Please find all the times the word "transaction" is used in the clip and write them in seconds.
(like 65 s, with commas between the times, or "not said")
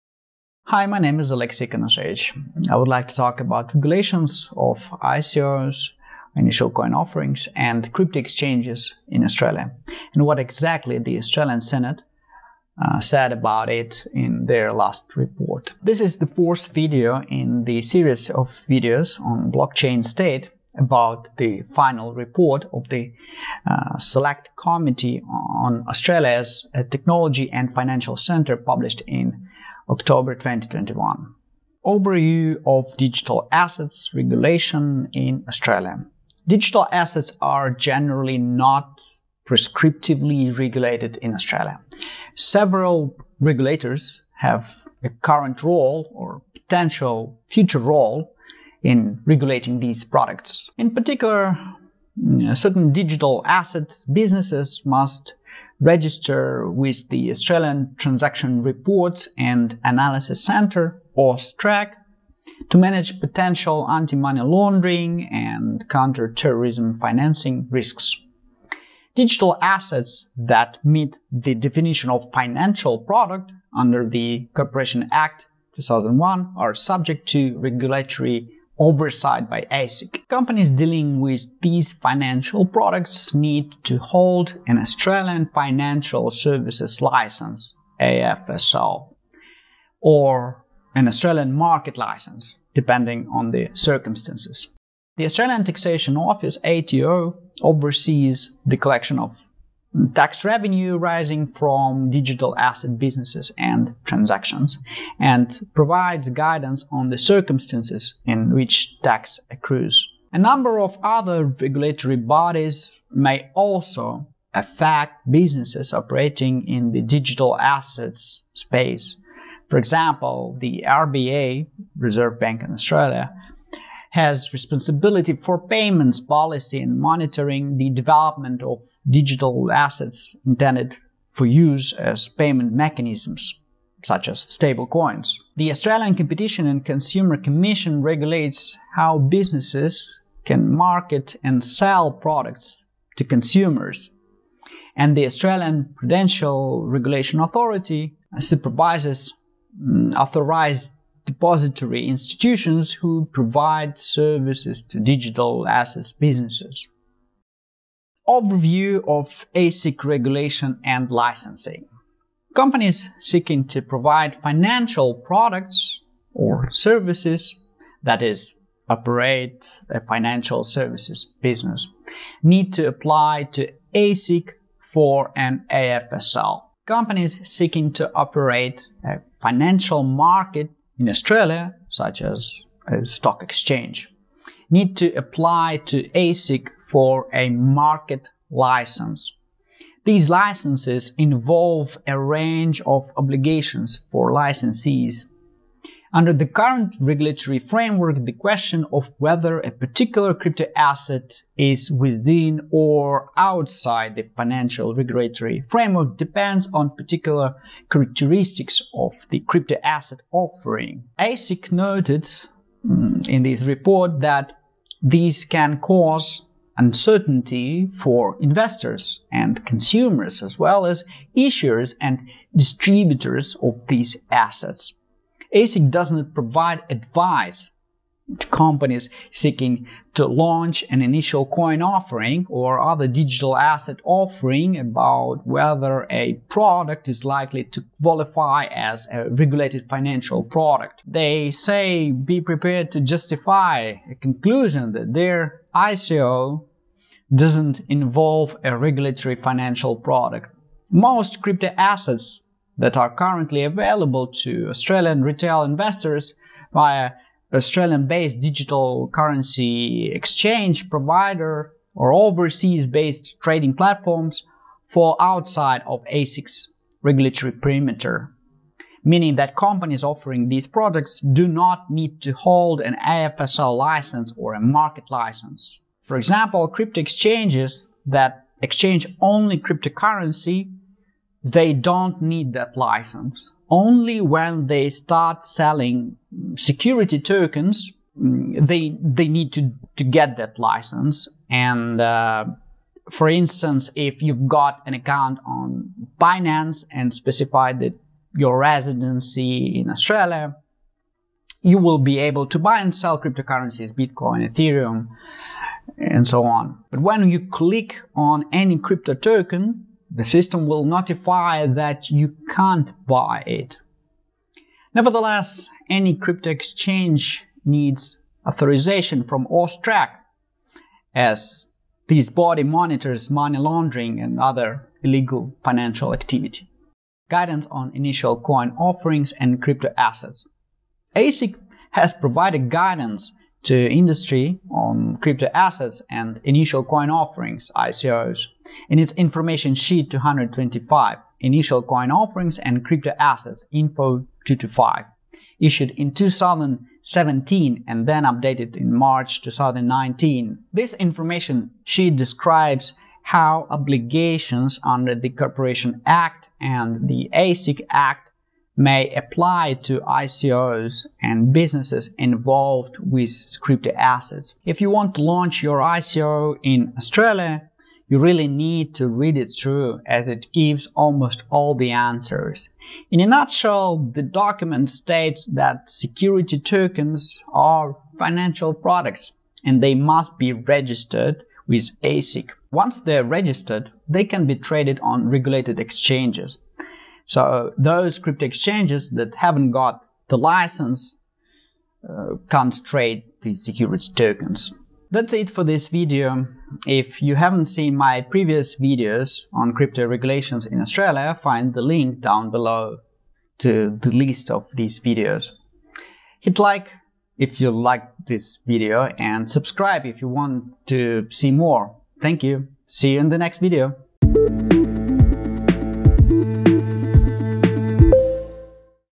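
57 s, 104 s.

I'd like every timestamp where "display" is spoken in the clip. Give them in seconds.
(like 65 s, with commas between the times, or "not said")
not said.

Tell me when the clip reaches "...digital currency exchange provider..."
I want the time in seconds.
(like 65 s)
258 s.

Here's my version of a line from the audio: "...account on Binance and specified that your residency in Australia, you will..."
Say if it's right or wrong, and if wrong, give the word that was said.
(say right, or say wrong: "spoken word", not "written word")
right.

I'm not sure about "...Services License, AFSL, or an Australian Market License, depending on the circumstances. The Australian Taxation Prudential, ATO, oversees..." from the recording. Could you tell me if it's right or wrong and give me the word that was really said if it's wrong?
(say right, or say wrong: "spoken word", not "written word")
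wrong: "Office", not "Prudential".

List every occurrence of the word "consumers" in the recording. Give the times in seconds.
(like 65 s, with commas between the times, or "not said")
136 s, 143 s, 219 s.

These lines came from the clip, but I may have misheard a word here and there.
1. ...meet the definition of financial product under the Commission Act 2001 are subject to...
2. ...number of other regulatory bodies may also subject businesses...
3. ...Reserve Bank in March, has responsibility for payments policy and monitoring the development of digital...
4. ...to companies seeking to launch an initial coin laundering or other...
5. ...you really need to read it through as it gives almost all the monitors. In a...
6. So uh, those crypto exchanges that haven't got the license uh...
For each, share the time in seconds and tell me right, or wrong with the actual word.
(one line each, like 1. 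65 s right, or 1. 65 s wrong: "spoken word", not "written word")
1. 70 s wrong: "Corporation", not "Commission"
2. 110 s wrong: "affect", not "subject"
3. 121 s wrong: "Australia", not "March"
4. 228 s wrong: "offering", not "laundering"
5. 368 s wrong: "answers", not "monitors"
6. 387 s right.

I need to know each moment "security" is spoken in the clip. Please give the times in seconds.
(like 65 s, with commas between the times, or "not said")
286 s, 375 s, 393 s.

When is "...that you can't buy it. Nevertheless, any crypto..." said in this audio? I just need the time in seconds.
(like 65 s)
311 s.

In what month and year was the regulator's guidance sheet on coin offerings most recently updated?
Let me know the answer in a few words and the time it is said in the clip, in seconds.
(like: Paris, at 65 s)
March 2019, at 348 s.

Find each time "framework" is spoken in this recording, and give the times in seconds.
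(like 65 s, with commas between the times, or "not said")
197 s, 205 s.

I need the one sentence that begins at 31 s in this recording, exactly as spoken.
Overview of digital assets regulation in Australia.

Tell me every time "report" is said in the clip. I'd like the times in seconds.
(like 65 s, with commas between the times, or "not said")
15 s, 22 s, 58 s, 213 s.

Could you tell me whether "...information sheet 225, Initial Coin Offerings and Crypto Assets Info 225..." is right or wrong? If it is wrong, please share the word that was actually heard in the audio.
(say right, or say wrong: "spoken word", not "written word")
right.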